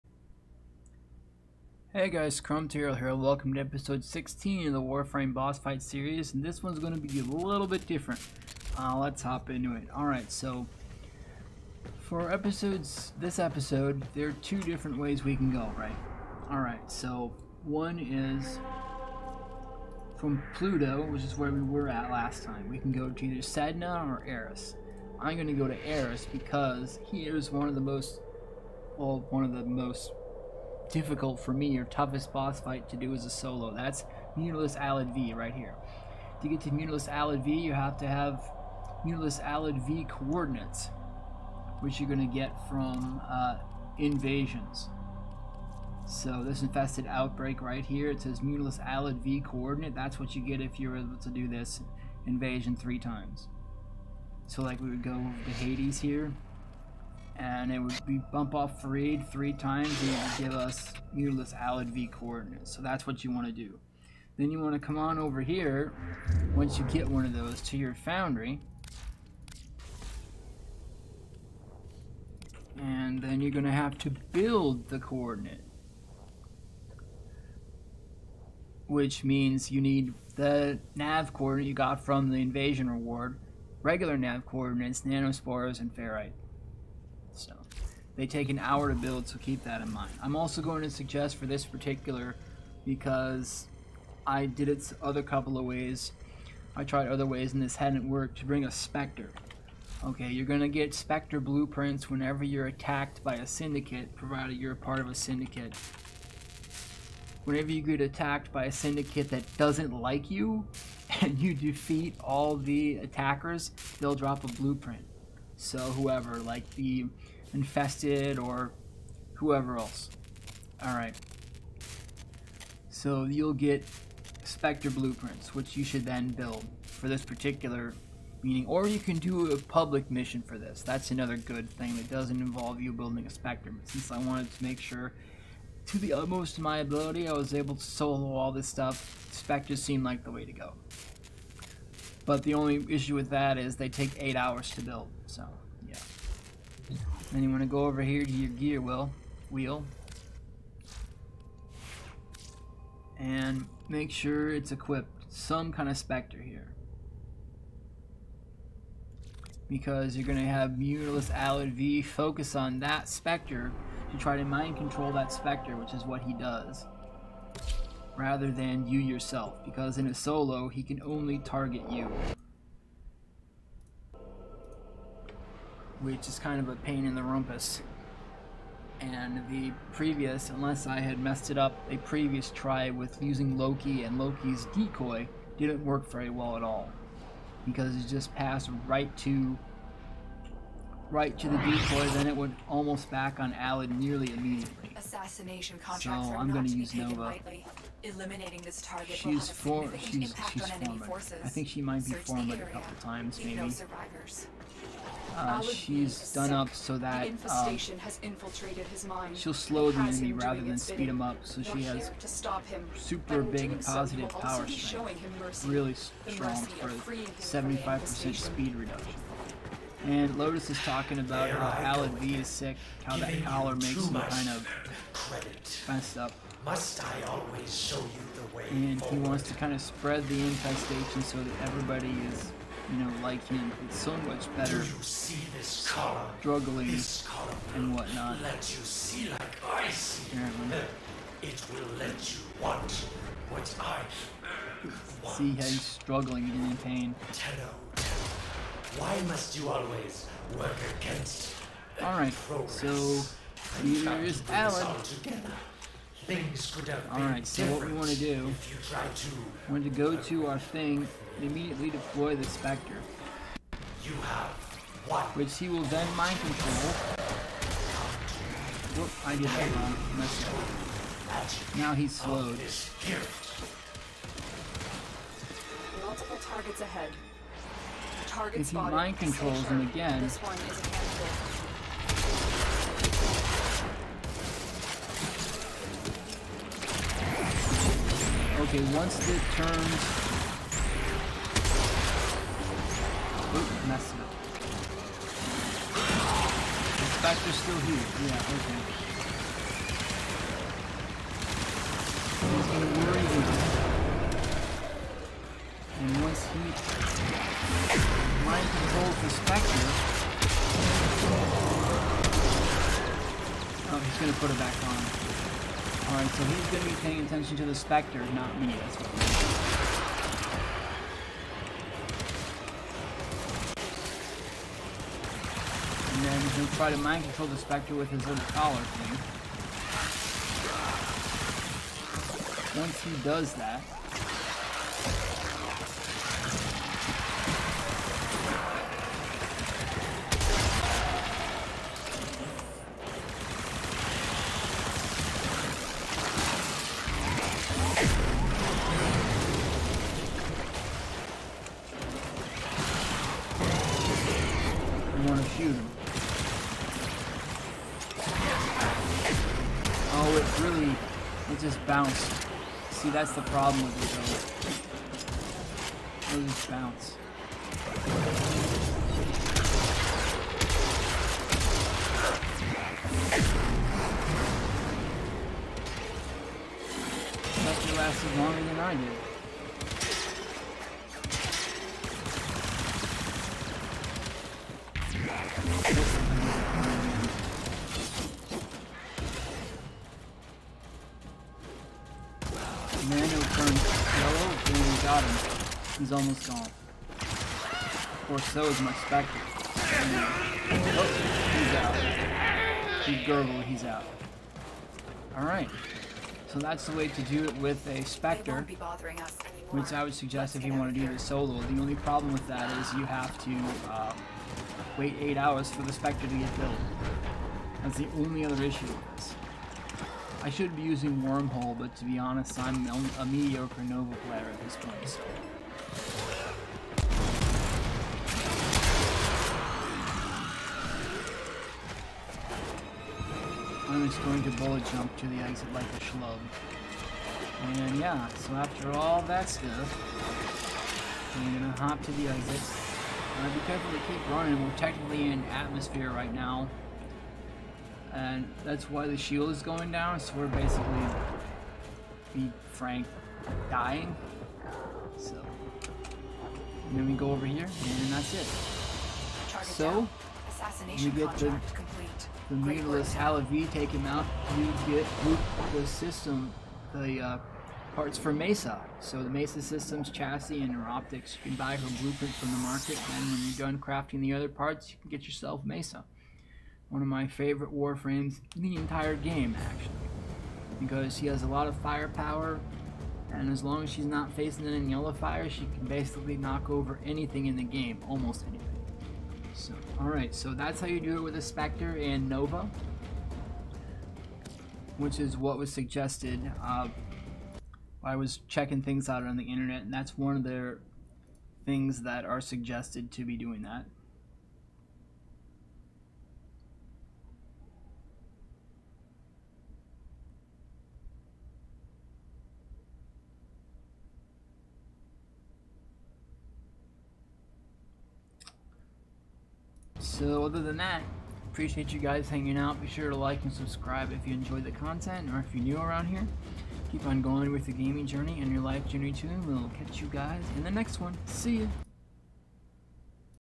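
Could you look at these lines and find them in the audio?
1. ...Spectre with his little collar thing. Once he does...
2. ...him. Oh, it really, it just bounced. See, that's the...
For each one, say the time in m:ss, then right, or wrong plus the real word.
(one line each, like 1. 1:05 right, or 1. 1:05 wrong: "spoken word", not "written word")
1. 5:27 right
2. 5:55 right.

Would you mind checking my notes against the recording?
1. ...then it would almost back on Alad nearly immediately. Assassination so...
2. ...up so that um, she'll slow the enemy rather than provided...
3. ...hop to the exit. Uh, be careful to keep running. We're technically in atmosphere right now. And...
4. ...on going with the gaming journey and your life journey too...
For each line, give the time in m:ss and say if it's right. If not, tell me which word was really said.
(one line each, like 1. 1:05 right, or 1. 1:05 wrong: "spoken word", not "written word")
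1. 3:12 right
2. 3:26 wrong: "speed", not "provided"
3. 7:21 right
4. 8:47 right.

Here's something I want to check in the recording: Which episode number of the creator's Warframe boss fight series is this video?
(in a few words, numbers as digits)
16.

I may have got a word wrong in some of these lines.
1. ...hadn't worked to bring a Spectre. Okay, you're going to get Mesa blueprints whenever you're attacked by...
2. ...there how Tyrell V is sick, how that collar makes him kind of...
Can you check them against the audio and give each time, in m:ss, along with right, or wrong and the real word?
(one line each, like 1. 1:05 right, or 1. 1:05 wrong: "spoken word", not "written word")
1. 1:37 wrong: "Spectre", not "Mesa"
2. 3:41 wrong: "Alad", not "Tyrell".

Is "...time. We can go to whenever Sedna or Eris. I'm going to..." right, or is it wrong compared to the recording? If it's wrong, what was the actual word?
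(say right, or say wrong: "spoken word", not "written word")
wrong: "either", not "whenever".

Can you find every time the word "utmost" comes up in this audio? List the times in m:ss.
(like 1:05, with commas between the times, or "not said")
2:16.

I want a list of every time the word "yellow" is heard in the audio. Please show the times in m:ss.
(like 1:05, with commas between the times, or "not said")
6:34, 8:04.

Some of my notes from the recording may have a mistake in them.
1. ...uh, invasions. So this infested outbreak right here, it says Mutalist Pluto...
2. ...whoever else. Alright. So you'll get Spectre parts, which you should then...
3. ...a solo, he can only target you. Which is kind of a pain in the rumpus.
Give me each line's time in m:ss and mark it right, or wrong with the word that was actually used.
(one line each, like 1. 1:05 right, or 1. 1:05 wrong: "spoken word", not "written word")
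1. 0:43 wrong: "Alad", not "Pluto"
2. 1:59 wrong: "blueprints", not "parts"
3. 2:50 right.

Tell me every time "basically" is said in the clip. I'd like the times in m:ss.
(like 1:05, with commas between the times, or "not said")
7:30, 8:05.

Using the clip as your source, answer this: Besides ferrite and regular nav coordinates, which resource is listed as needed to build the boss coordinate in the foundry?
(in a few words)
Nanospores.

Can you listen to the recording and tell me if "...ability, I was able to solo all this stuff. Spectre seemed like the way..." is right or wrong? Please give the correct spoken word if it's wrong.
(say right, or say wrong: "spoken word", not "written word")
right.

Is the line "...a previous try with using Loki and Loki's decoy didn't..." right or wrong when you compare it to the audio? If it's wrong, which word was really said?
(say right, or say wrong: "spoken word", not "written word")
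right.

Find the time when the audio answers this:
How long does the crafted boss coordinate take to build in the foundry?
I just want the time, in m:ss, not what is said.
1:28.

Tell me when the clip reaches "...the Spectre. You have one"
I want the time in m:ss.
4:22.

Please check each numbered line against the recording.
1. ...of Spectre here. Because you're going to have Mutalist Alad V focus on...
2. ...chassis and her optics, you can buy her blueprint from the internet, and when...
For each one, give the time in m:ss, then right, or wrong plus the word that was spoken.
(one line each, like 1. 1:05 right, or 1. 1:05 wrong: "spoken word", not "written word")
1. 2:35 right
2. 7:50 wrong: "market", not "internet".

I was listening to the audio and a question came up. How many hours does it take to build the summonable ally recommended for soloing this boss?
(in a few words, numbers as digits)
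8.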